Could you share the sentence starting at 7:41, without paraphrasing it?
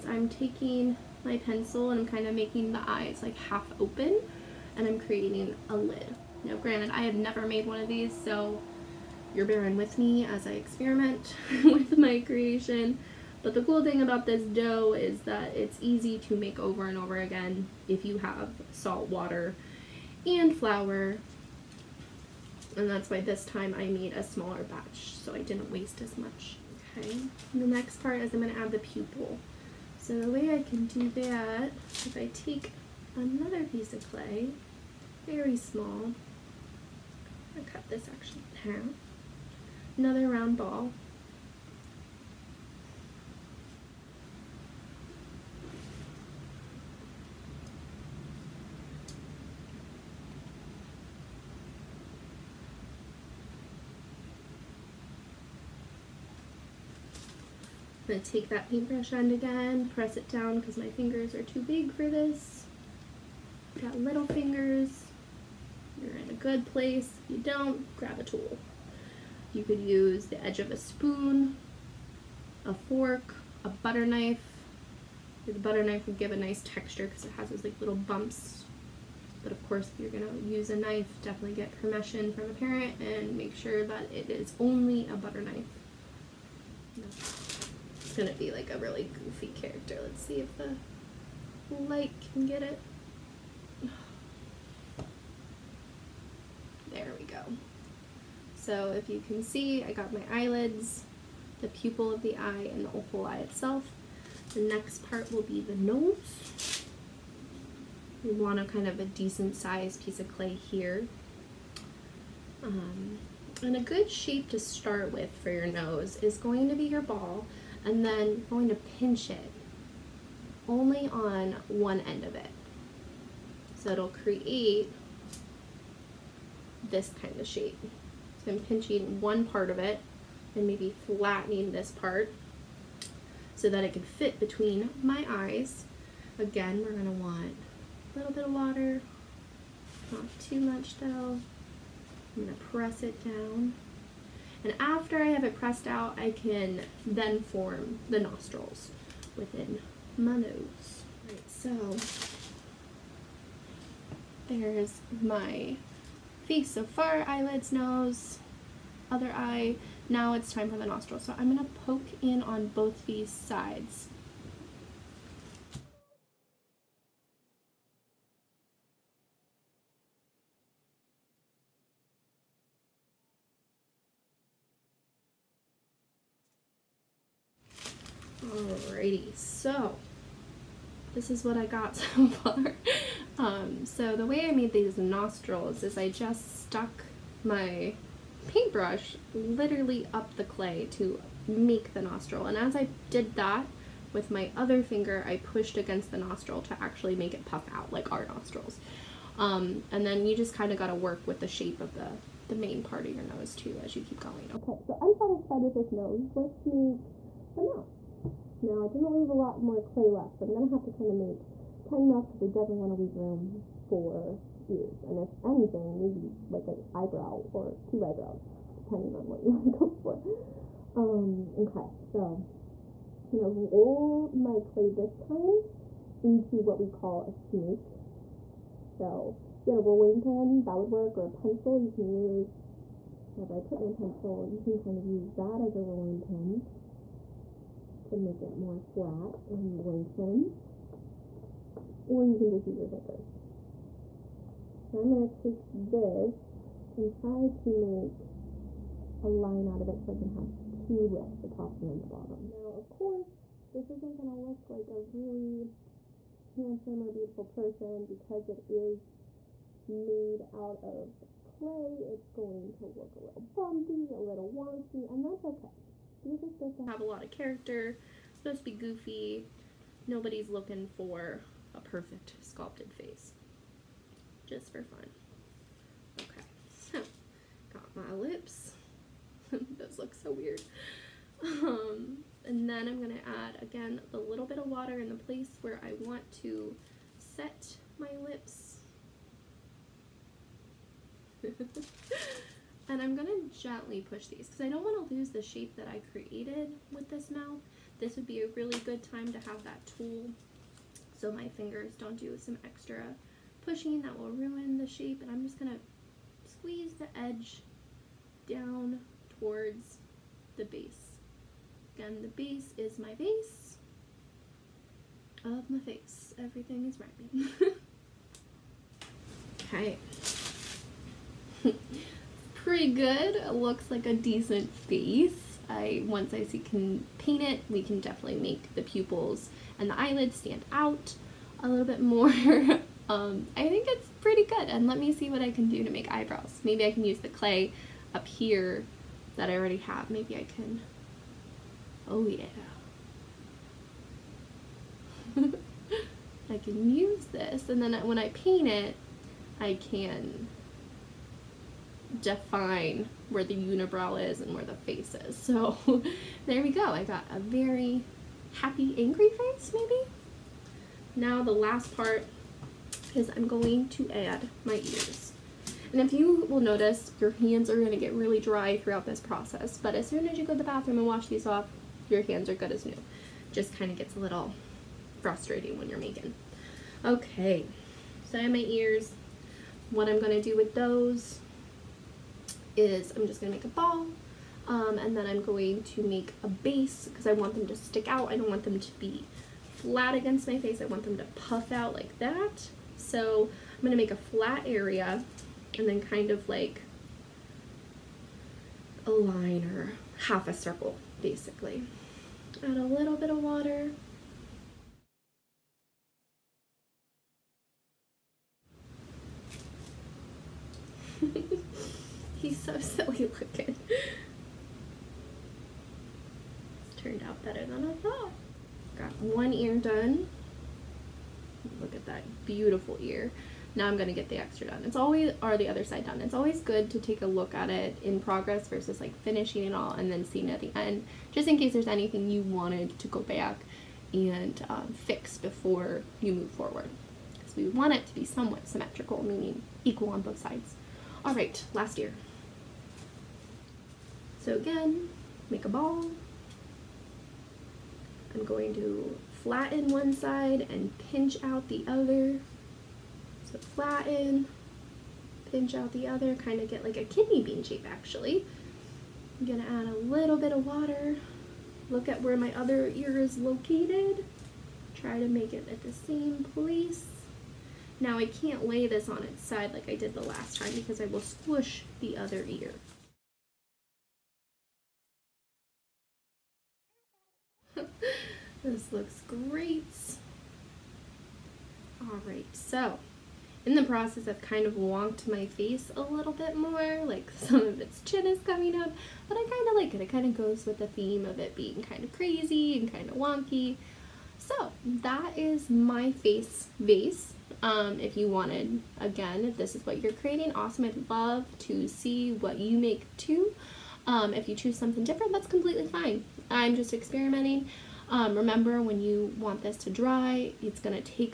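Look at where my other ear is located.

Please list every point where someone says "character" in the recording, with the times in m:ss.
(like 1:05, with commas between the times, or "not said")
1:29, 4:27.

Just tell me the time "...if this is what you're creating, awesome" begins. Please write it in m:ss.
8:19.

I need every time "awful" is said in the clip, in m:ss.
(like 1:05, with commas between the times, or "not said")
not said.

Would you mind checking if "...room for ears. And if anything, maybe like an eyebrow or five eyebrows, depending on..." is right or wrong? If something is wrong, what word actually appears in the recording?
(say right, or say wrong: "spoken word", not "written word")
wrong: "two", not "five".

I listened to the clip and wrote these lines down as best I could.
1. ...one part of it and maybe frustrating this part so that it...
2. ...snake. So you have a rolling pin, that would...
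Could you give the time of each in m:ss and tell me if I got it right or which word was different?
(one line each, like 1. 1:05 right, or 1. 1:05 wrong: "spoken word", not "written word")
1. 2:09 wrong: "flattening", not "frustrating"
2. 3:47 right.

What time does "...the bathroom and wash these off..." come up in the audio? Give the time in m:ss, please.
6:10.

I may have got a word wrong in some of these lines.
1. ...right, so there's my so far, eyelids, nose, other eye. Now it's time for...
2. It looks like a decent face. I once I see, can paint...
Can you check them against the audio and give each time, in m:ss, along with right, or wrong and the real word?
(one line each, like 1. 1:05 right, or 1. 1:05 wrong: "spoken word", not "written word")
1. 2:31 right
2. 5:23 right.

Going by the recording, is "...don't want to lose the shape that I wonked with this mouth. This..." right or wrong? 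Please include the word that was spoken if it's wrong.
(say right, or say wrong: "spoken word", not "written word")
wrong: "created", not "wonked".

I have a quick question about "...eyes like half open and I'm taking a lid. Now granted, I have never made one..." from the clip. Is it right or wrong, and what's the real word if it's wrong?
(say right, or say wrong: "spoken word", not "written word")
wrong: "creating", not "taking".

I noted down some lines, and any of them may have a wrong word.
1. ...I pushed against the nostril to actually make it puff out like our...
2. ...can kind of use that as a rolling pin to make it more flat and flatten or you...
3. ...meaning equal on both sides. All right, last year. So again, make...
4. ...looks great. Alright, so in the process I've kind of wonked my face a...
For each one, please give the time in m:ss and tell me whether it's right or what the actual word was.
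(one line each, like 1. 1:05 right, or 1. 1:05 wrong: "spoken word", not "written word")
1. 3:15 right
2. 3:54 wrong: "lengthen", not "flatten"
3. 7:19 right
4. 7:58 right.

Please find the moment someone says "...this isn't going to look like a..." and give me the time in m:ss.
4:13.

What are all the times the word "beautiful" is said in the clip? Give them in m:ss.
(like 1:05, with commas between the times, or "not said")
4:17, 7:02.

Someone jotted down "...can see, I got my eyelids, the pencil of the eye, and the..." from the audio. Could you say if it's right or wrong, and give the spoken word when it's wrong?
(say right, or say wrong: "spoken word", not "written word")
wrong: "pupil", not "pencil".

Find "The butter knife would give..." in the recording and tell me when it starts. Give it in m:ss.
1:15.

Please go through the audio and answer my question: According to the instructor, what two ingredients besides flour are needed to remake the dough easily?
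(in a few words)
salt water.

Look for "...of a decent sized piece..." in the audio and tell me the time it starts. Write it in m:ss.
1:48.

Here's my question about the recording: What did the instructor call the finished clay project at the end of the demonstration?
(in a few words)
face vase.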